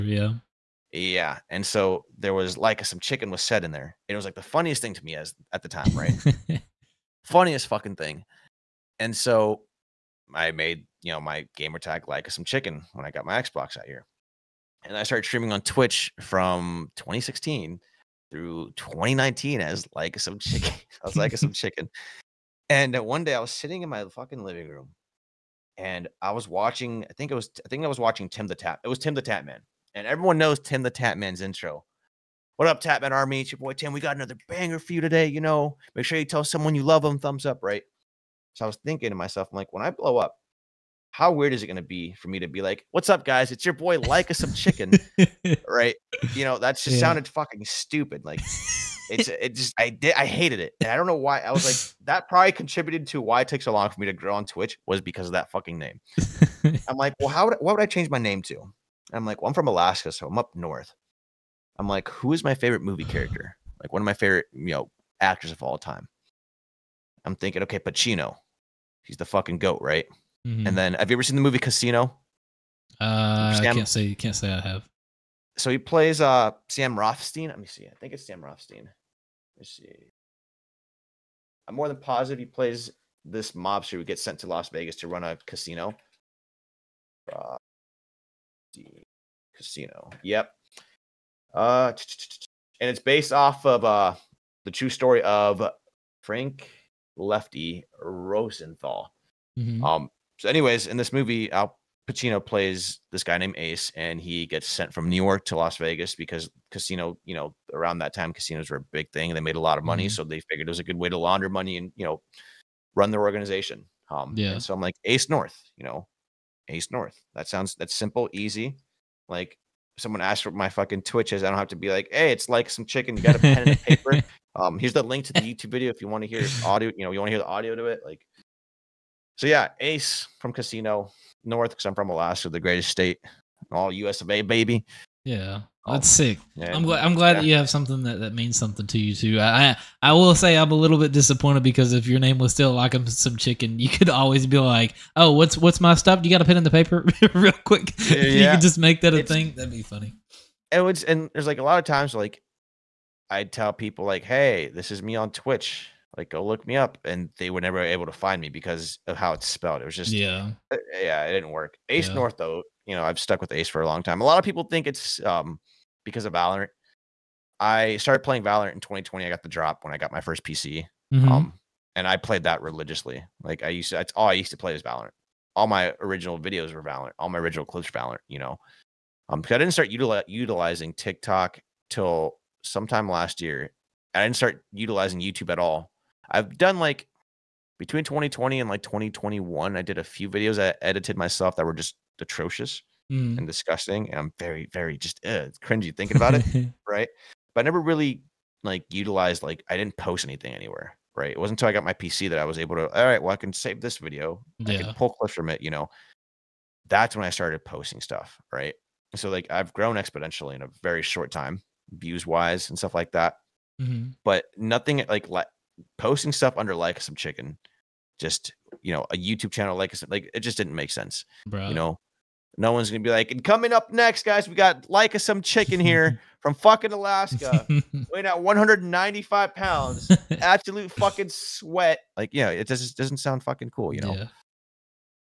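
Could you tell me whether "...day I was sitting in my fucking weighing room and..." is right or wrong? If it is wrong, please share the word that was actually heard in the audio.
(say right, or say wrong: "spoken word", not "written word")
wrong: "living", not "weighing".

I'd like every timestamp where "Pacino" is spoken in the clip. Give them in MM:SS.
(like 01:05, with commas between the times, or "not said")
01:07, 01:42.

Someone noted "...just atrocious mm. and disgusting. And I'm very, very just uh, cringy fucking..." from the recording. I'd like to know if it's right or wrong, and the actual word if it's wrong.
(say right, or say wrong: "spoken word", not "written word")
wrong: "thinking", not "fucking".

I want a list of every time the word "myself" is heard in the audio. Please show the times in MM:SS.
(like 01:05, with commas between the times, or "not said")
00:39, 03:11.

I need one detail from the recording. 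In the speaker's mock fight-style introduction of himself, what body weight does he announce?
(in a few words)
195 pounds.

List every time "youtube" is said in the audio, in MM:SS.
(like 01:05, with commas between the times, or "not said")
02:05, 03:05, 03:39.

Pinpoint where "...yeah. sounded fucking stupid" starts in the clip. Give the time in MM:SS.
00:46.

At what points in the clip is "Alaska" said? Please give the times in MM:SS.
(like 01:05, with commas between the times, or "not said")
00:59, 02:12, 03:46.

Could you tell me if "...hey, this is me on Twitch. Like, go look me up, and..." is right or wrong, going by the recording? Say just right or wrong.
right.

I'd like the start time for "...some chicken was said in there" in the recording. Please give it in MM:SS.
00:02.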